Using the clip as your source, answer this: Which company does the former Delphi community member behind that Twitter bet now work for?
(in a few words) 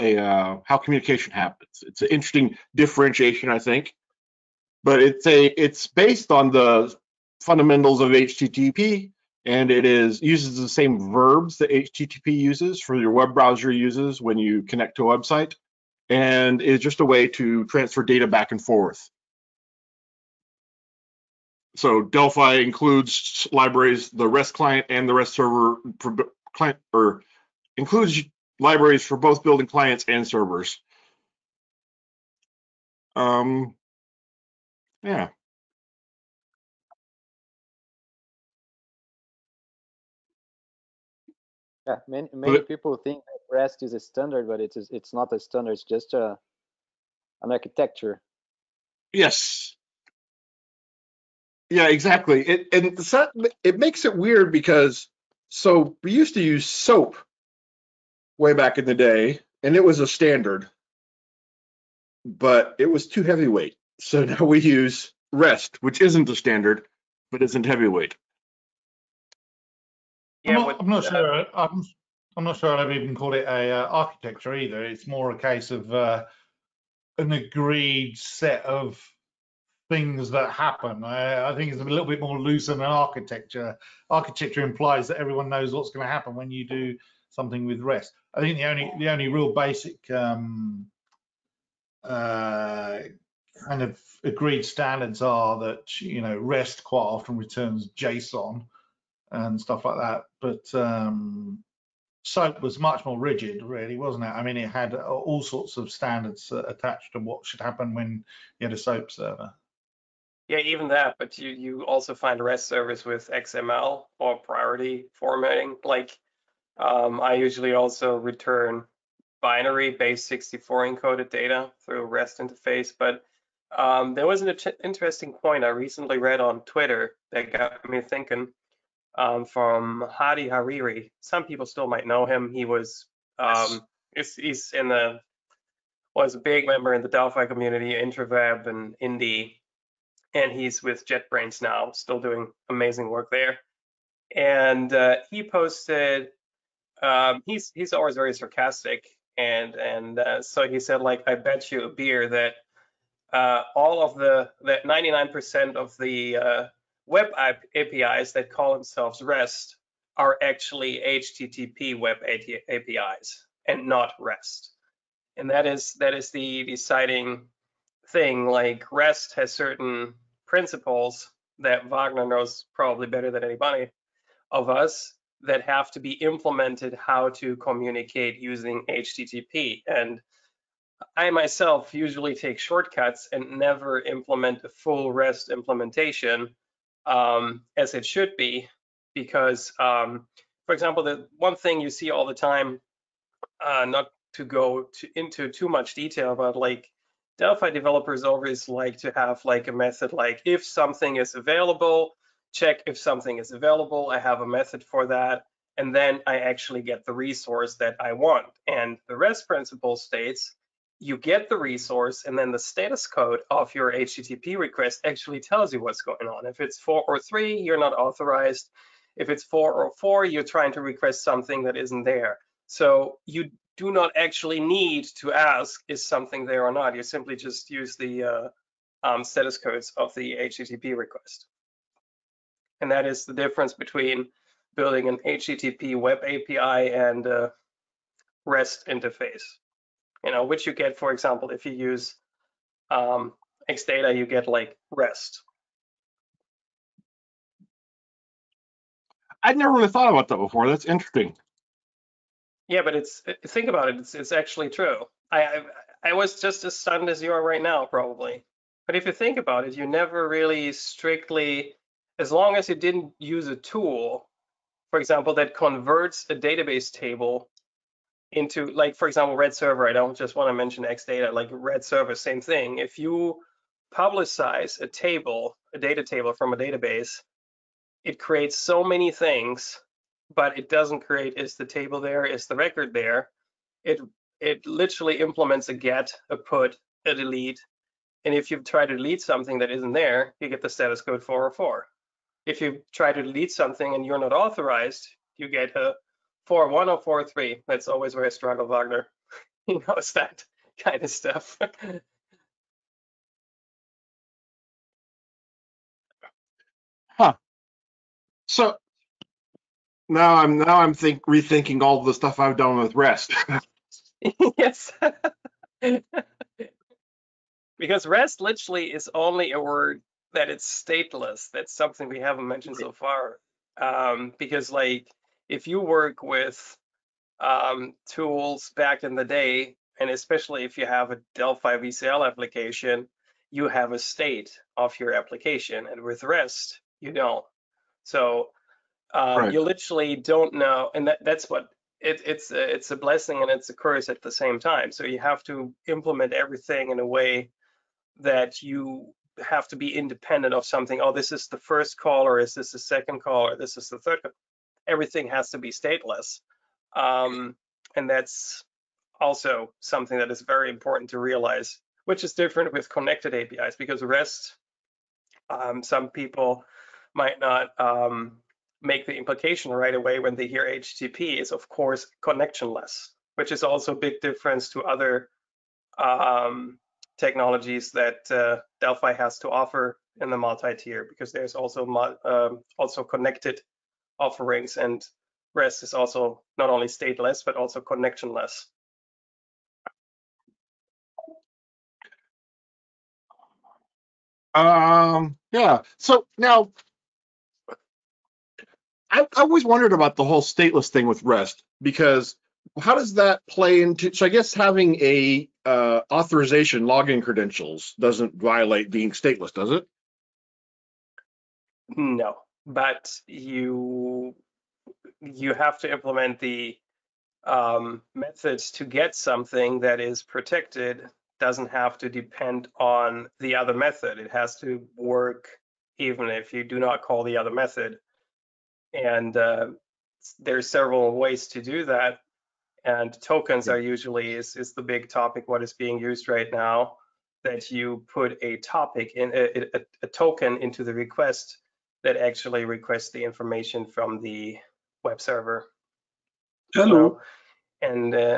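JetBrains.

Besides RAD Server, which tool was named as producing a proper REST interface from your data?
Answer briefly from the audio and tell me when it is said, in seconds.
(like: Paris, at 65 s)
XData, at 243 s.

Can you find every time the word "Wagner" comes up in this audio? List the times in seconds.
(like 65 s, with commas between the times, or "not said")
171 s, 298 s.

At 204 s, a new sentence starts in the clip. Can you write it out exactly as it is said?
I have a method for that.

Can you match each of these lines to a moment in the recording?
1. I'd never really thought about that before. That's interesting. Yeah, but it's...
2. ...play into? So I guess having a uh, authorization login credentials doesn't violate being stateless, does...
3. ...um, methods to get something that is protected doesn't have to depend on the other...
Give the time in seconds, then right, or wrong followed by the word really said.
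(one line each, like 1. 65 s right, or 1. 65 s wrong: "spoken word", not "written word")
1. 249 s right
2. 403 s right
3. 417 s right.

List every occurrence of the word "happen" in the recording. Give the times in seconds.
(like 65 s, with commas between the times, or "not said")
1 s, 80 s, 86 s, 107 s.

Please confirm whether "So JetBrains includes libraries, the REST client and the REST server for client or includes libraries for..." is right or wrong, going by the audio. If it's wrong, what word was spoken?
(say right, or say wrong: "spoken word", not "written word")
wrong: "Delphi", not "JetBrains".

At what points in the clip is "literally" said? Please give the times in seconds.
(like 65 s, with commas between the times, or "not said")
284 s, 318 s, 339 s.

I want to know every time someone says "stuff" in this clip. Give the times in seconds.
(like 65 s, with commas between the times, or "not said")
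99 s, 301 s, 312 s.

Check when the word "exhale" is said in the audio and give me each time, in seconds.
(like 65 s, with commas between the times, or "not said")
not said.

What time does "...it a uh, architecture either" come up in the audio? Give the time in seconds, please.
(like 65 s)
73 s.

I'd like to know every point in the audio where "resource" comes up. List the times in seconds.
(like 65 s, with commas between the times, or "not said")
207 s, 211 s.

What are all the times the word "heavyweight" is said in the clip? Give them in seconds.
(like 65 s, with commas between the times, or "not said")
63 s, 67 s.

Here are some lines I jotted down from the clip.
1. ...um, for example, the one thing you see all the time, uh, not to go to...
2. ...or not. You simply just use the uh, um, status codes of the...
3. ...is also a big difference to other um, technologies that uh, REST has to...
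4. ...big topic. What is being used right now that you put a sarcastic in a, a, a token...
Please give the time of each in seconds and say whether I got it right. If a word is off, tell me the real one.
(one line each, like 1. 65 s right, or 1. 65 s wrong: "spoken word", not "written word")
1. 189 s right
2. 226 s right
3. 373 s wrong: "Delphi", not "REST"
4. 434 s wrong: "topic", not "sarcastic".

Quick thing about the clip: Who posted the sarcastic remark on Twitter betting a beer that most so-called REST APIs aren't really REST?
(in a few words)
Hadi Hariri.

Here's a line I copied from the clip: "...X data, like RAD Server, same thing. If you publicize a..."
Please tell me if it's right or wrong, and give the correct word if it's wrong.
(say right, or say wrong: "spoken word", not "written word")
right.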